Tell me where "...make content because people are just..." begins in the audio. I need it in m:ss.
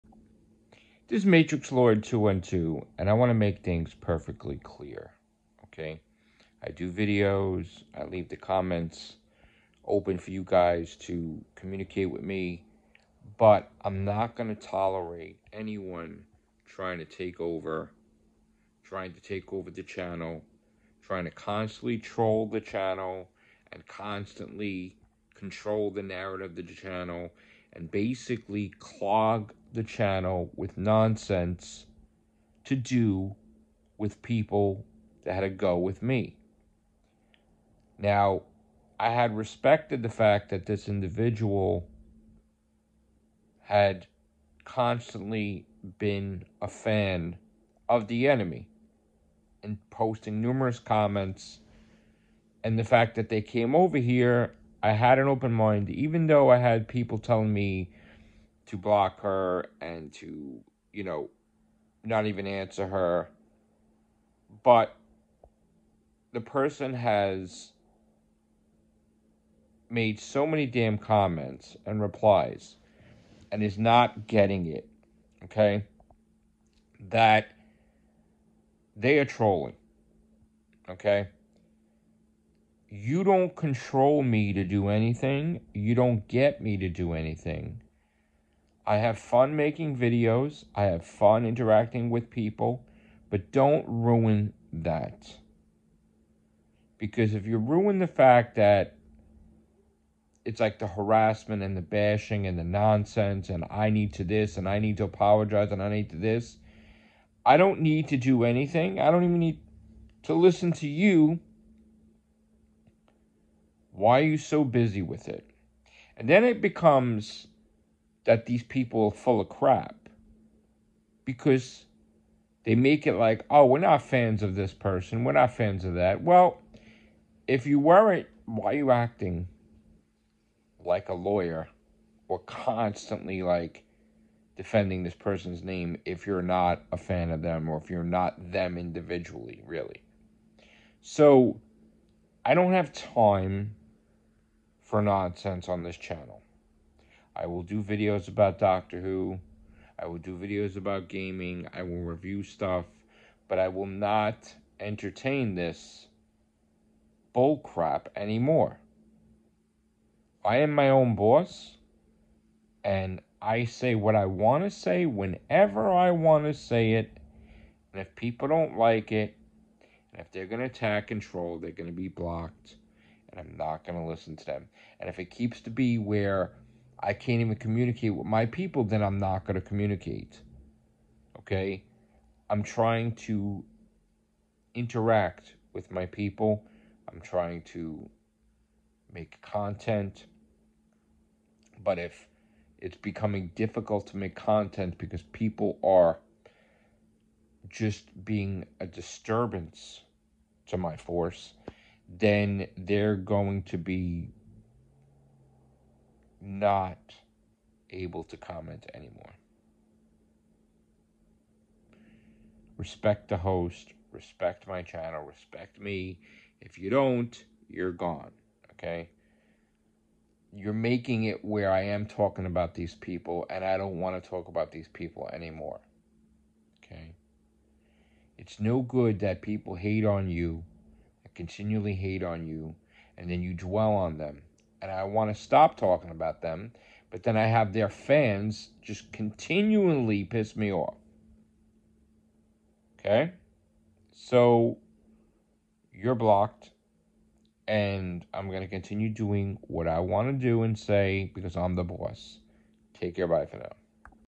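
3:14.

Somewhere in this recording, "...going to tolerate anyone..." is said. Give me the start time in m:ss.
0:14.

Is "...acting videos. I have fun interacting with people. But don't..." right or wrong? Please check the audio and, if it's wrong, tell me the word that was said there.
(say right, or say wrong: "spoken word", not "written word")
wrong: "making", not "acting".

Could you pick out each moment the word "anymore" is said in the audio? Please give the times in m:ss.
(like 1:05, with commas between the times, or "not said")
2:38, 3:28, 3:45.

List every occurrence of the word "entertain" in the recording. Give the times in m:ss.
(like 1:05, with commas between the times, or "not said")
2:34.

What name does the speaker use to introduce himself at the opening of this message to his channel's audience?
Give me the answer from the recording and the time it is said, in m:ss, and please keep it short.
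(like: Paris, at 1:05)
Matrix Lord 212, at 0:01.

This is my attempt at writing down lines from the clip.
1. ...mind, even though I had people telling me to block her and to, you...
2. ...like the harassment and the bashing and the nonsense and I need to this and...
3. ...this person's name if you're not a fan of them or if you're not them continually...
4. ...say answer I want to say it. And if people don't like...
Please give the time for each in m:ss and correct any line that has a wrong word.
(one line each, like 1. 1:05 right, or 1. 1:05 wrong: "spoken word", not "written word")
1. 0:55 right
2. 1:40 right
3. 2:15 wrong: "individually", not "continually"
4. 2:44 wrong: "whenever", not "answer".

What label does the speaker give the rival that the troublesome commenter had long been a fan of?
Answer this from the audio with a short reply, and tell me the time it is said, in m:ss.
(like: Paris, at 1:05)
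the enemy, at 0:48.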